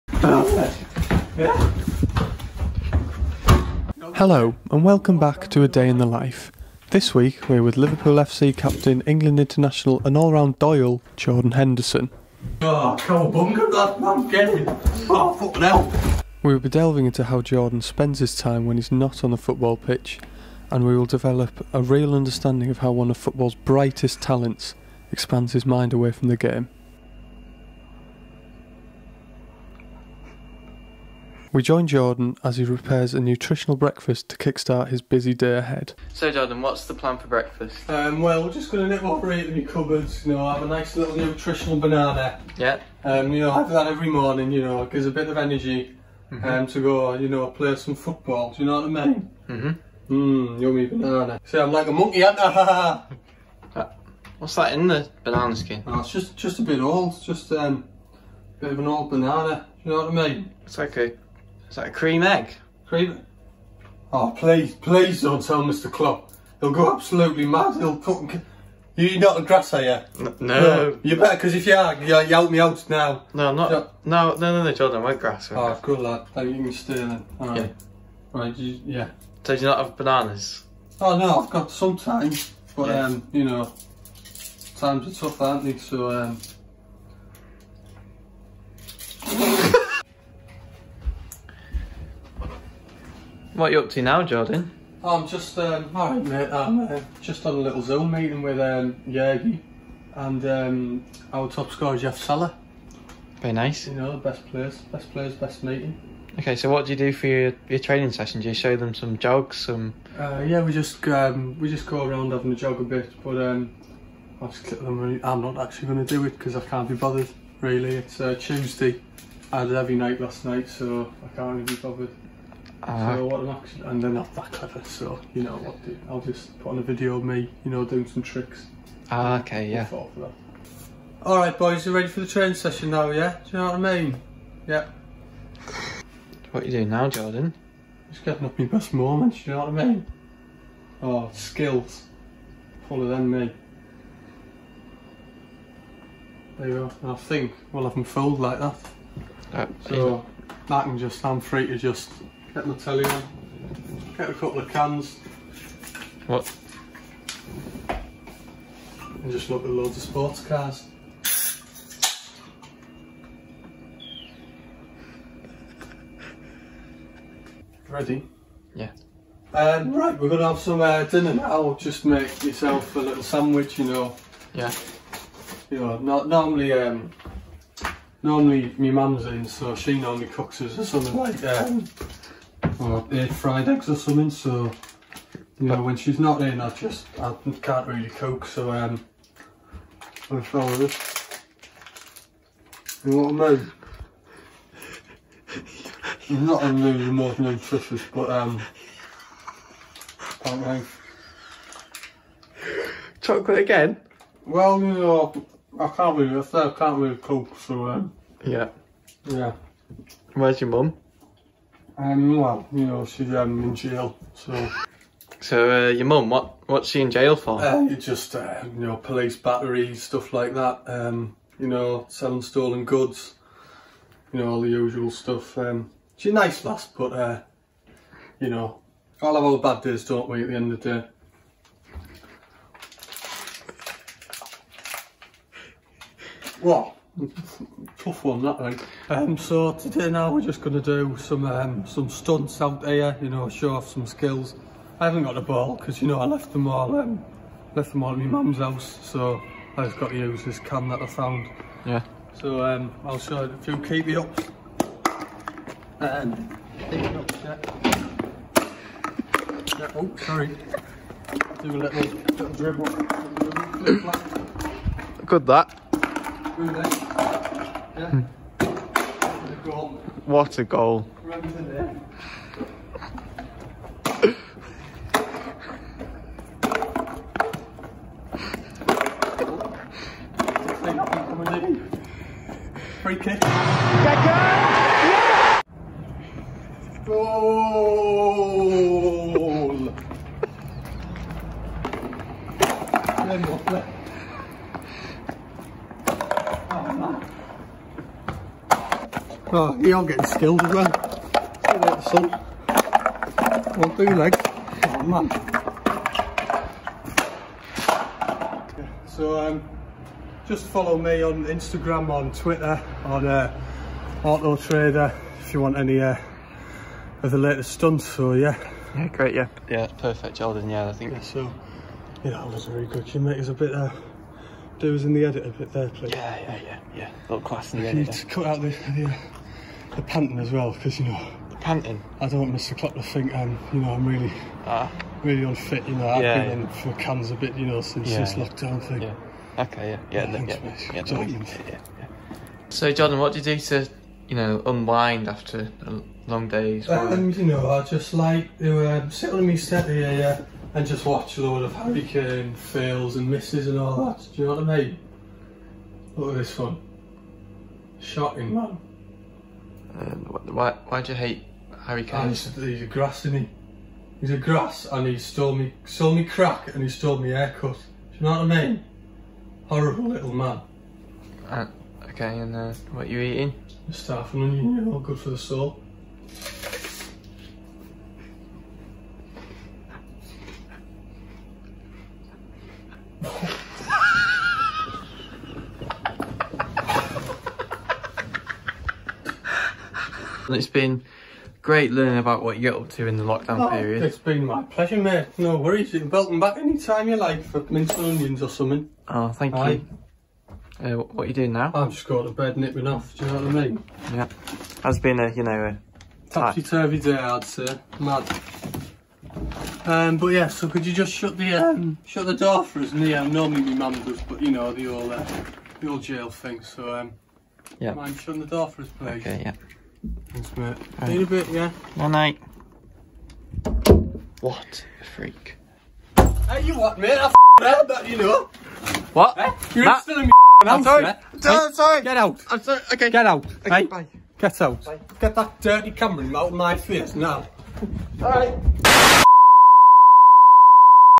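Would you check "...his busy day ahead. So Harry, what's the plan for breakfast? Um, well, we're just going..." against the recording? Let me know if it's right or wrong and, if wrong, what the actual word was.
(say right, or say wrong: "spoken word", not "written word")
wrong: "Jordan", not "Harry".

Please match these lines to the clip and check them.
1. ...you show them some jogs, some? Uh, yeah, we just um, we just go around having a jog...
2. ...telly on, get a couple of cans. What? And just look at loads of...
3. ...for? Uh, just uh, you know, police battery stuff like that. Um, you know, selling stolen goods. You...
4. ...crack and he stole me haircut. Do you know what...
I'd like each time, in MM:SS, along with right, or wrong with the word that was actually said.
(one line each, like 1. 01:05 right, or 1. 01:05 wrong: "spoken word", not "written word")
1. 01:48 right
2. 02:32 right
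3. 03:37 right
4. 06:06 right.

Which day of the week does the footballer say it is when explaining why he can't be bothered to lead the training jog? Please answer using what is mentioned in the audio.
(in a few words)
Tuesday.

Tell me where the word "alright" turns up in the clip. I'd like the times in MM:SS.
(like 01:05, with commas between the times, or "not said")
01:35, 07:18.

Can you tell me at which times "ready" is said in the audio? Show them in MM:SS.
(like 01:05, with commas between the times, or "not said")
02:11, 02:47.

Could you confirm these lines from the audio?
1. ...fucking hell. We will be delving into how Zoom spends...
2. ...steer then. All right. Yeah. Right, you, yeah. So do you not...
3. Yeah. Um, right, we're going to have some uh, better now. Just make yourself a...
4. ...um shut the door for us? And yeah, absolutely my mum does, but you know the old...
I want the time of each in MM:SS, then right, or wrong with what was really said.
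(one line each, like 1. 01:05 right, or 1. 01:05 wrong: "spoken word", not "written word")
1. 00:15 wrong: "Jordan", not "Zoom"
2. 01:16 right
3. 02:48 wrong: "dinner", not "better"
4. 06:51 wrong: "normally", not "absolutely".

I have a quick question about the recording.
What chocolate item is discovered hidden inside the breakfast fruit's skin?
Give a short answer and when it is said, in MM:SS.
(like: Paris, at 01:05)
Cream egg, at 01:01.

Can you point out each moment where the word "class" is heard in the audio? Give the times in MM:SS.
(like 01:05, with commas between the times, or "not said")
05:27.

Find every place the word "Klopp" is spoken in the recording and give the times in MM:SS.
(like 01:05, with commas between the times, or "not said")
01:05, 05:32.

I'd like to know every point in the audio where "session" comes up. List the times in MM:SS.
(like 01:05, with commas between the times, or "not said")
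01:48, 02:12.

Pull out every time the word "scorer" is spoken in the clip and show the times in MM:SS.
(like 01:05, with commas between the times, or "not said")
01:41.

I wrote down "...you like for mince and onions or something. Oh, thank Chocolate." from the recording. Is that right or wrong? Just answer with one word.
wrong.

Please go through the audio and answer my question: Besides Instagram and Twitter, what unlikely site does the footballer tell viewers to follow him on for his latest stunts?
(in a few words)
Auto Trader.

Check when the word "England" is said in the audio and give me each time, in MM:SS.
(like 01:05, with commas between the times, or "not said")
00:09.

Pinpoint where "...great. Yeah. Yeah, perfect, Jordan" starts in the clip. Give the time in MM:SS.
05:19.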